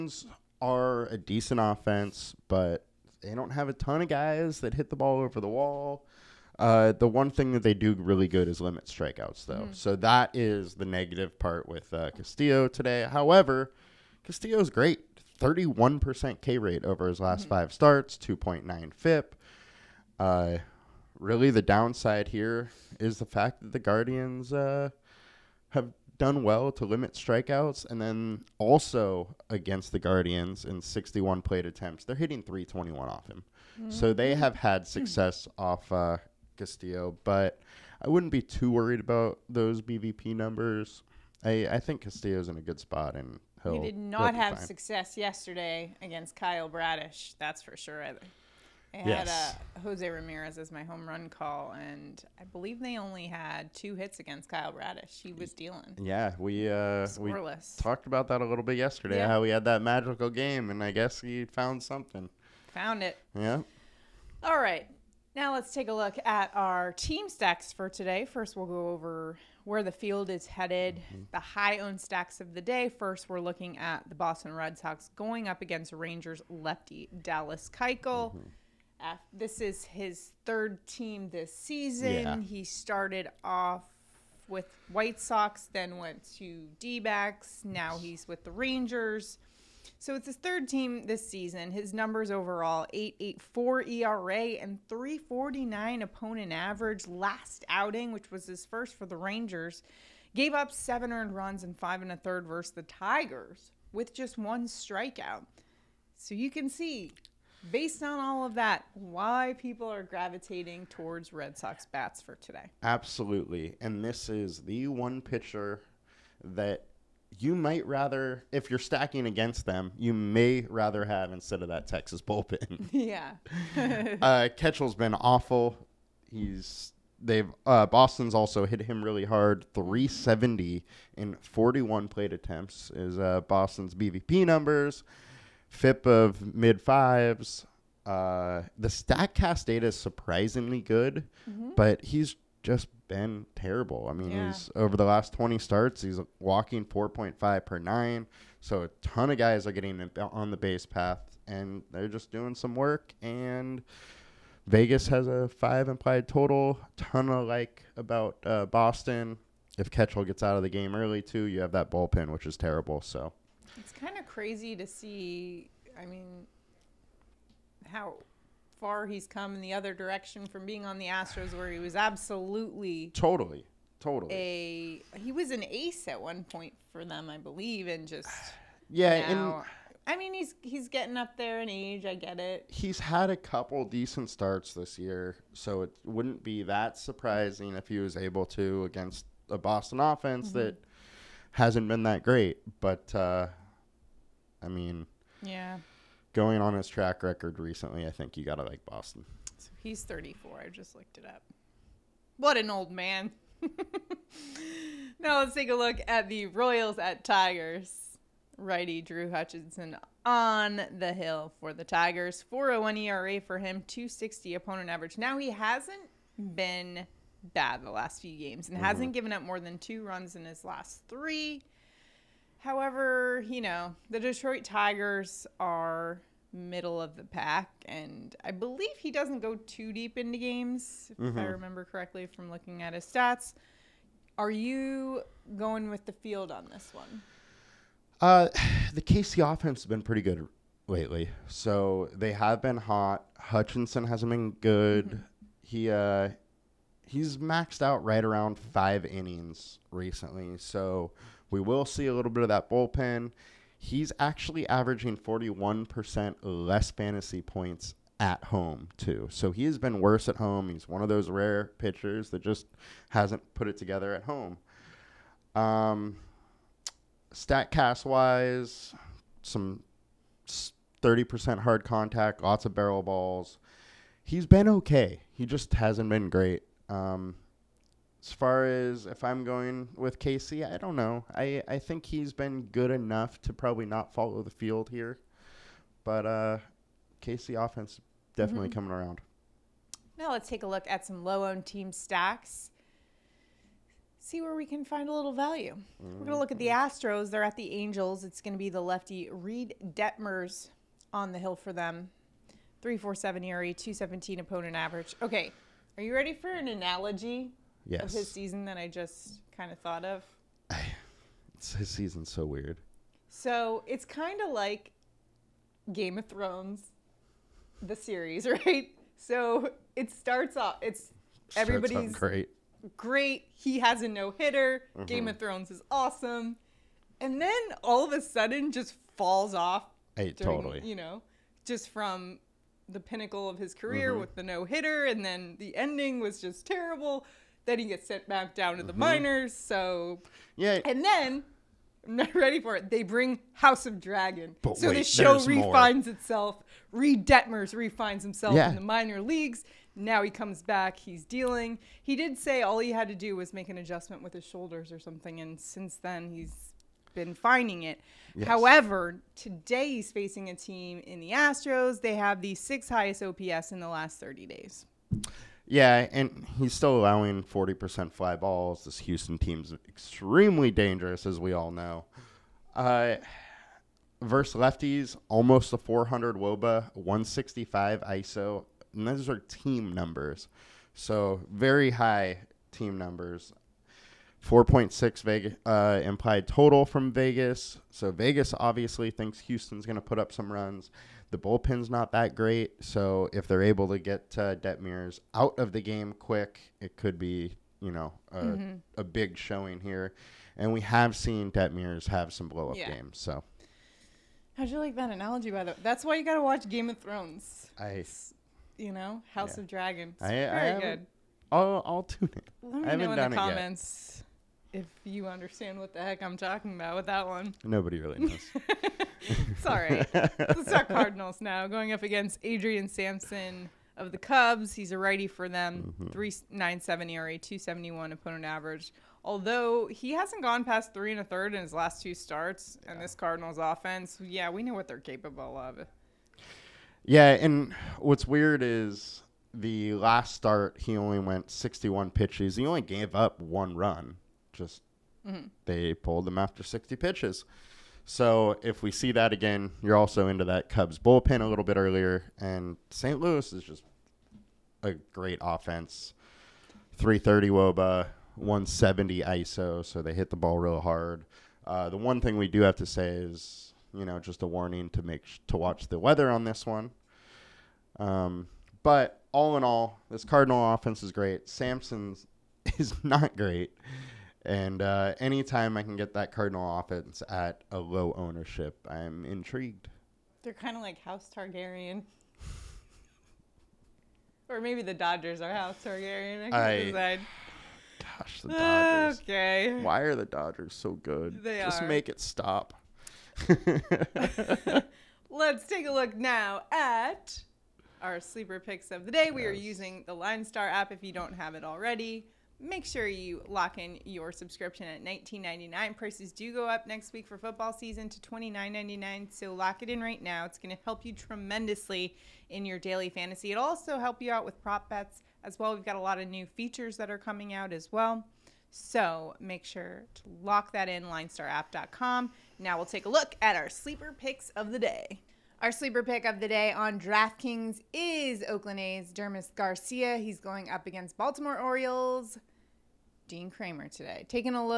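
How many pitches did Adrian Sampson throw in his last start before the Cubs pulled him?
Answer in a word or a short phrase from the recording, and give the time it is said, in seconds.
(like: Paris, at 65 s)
61, at 441 s.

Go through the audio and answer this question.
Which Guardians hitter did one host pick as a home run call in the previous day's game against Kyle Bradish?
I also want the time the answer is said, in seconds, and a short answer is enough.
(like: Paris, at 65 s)
Jose Ramirez, at 49 s.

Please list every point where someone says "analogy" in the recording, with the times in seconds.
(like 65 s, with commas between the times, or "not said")
306 s, 405 s.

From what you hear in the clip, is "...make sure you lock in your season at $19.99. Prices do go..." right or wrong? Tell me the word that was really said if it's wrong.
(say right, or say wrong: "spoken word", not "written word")
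wrong: "subscription", not "season".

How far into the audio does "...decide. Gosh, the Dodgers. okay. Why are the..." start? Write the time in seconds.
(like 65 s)
486 s.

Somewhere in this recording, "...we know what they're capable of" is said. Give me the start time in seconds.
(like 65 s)
434 s.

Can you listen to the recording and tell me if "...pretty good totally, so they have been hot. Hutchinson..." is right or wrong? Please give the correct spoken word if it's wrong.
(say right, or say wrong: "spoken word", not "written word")
wrong: "lately", not "totally".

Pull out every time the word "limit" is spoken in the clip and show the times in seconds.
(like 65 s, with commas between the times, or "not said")
8 s, 26 s.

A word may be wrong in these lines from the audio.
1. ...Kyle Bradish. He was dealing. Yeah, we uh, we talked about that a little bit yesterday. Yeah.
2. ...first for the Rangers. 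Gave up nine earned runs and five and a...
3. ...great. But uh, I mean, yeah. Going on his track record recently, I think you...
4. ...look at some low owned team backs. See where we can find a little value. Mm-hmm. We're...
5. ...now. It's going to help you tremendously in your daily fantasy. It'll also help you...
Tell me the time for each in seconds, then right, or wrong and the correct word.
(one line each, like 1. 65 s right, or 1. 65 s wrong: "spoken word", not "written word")
1. 54 s right
2. 98 s wrong: "seven", not "nine"
3. 192 s right
4. 290 s wrong: "stacks", not "backs"
5. 510 s right.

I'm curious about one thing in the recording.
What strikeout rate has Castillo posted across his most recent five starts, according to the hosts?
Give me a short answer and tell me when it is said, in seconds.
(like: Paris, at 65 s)
31%, at 15 s.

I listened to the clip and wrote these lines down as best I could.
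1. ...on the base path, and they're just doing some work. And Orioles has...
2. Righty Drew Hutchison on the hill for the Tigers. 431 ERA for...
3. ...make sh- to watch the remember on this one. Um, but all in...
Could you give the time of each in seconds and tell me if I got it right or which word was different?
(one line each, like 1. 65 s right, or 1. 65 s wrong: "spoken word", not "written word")
1. 150 s wrong: "Vegas", not "Orioles"
2. 208 s wrong: "401", not "431"
3. 465 s wrong: "weather", not "remember".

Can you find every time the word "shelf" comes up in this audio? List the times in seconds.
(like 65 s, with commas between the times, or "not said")
not said.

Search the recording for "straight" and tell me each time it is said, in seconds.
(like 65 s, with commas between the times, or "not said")
not said.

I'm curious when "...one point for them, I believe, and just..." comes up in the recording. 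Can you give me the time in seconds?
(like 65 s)
176 s.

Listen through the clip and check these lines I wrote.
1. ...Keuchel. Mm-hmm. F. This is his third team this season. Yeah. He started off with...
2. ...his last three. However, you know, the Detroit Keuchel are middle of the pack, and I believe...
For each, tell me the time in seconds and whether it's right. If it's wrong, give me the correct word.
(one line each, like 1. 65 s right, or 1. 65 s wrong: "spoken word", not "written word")
1. 77 s right
2. 220 s wrong: "Tigers", not "Keuchel".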